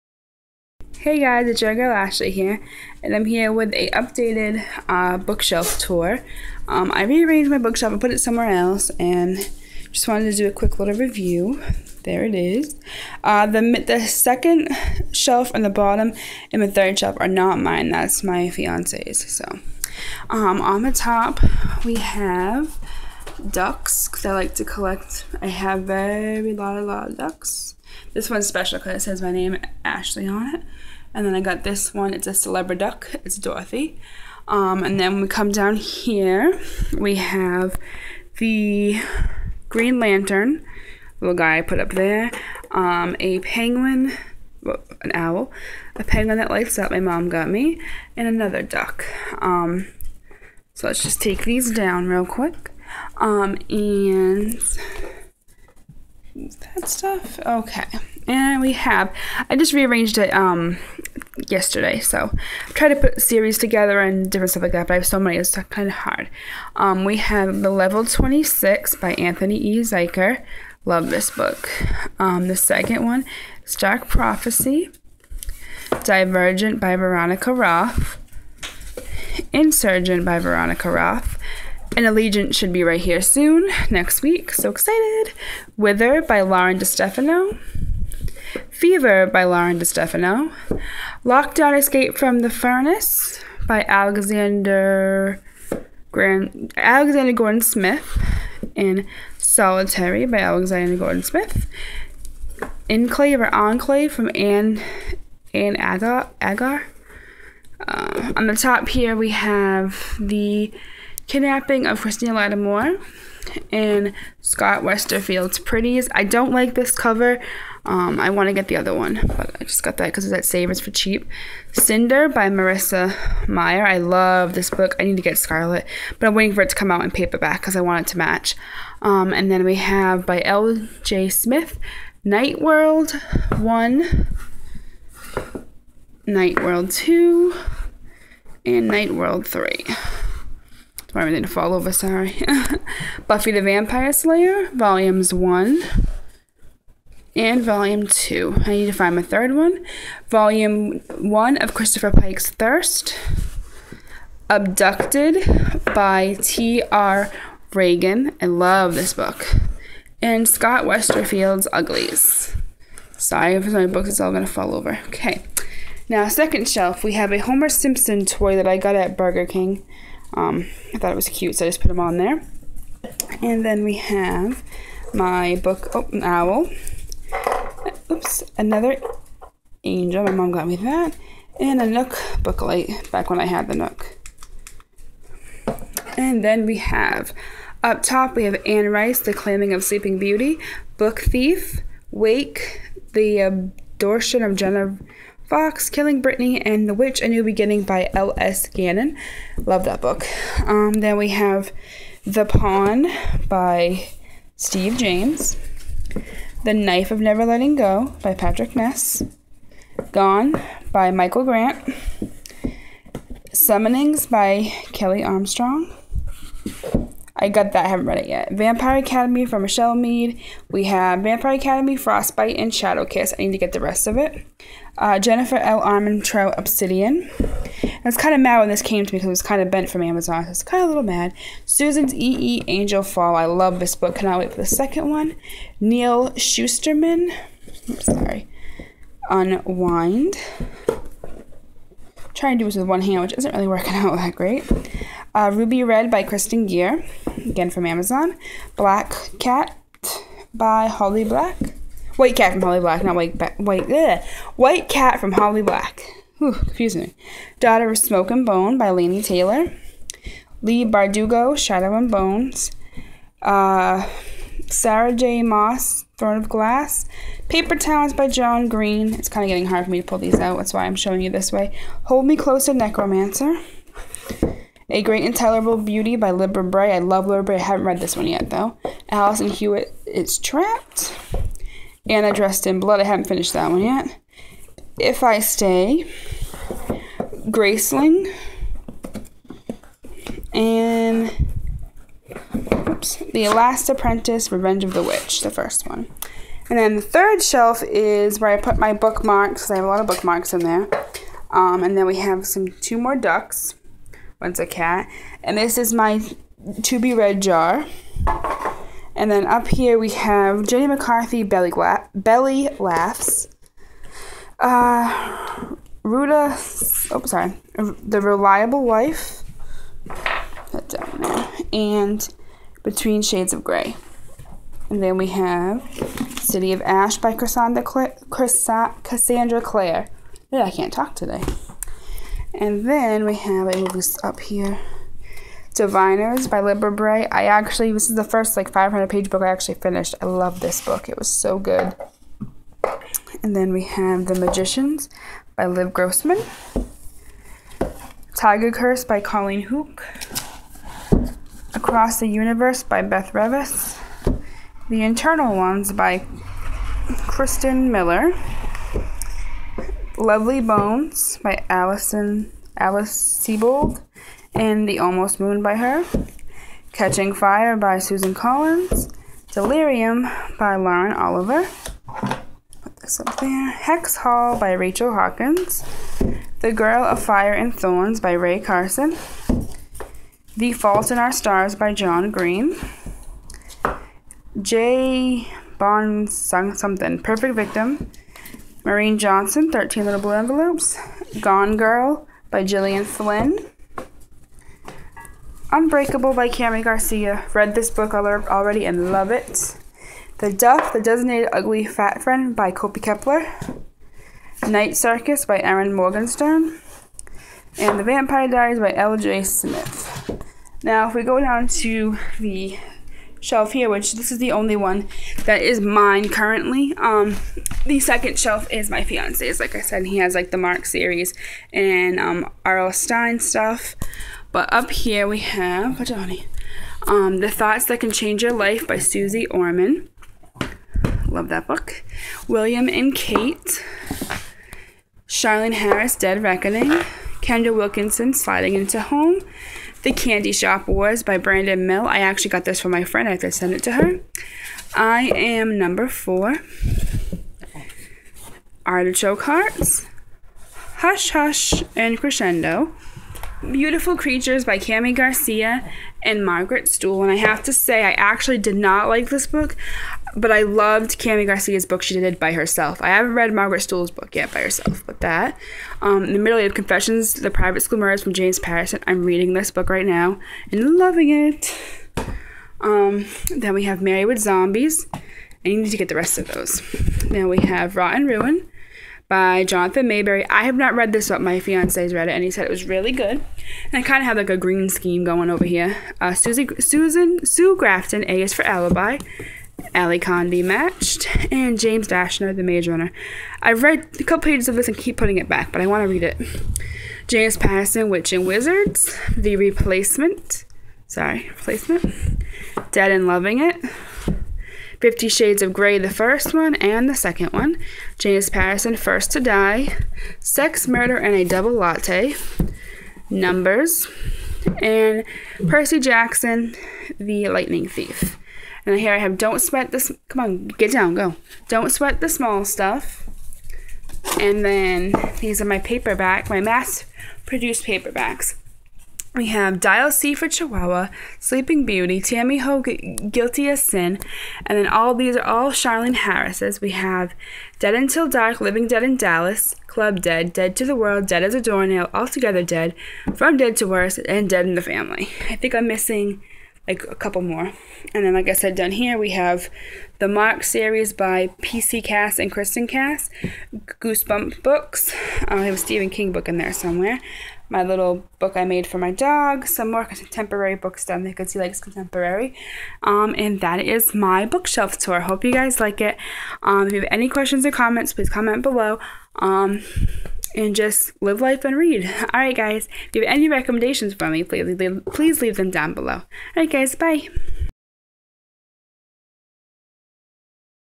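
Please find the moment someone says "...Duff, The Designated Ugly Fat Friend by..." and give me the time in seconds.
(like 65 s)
400 s.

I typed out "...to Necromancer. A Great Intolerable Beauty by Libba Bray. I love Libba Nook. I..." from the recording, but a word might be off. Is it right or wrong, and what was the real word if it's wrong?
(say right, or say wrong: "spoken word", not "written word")
wrong: "Bray", not "Nook".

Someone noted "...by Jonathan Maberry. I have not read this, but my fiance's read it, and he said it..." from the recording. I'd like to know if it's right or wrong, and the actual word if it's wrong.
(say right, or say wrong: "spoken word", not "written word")
right.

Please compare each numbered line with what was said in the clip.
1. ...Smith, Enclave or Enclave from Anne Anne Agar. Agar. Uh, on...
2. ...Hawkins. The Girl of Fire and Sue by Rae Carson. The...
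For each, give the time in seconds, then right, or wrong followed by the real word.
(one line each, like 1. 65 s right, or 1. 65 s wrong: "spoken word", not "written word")
1. 101 s right
2. 375 s wrong: "Thorns", not "Sue".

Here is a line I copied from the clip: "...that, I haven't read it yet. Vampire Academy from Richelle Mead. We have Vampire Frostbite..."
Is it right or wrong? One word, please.
wrong.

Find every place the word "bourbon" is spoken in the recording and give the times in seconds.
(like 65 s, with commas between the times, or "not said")
not said.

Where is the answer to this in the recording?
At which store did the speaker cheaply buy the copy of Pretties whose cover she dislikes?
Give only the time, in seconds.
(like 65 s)
120 s.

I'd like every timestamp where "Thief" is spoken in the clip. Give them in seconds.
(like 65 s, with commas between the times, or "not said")
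191 s, 517 s.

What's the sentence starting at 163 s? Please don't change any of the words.
Sorry if my books, it's all going to fall over.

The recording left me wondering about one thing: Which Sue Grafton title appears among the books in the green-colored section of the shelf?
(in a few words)
A is for Alibi.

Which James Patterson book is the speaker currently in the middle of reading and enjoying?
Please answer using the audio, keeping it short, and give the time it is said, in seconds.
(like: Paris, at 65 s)
The Private School Murders, at 467 s.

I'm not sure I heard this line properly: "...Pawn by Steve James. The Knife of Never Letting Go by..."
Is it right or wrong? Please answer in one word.
right.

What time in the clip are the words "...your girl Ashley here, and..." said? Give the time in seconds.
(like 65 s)
1 s.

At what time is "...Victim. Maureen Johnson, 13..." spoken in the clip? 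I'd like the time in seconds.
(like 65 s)
387 s.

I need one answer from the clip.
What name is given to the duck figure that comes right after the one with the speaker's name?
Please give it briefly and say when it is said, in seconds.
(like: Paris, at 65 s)
Dorothy, at 33 s.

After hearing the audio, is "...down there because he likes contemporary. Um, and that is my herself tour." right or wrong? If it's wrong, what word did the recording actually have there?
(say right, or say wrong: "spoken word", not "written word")
wrong: "bookshelf", not "herself".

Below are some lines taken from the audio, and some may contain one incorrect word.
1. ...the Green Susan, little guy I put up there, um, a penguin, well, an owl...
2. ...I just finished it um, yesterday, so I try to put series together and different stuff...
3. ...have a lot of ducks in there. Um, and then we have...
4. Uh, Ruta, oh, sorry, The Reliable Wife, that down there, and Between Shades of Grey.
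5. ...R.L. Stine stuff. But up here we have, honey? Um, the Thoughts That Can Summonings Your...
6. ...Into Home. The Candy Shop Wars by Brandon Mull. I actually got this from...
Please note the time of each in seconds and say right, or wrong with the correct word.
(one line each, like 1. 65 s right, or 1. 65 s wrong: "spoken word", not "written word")
1. 38 s wrong: "Lantern", not "Susan"
2. 59 s wrong: "rearranged", not "finished"
3. 299 s wrong: "bookmarks", not "ducks"
4. 314 s right
5. 422 s wrong: "Change", not "Summonings"
6. 438 s right.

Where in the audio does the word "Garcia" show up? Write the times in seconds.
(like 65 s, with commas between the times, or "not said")
396 s, 455 s, 461 s.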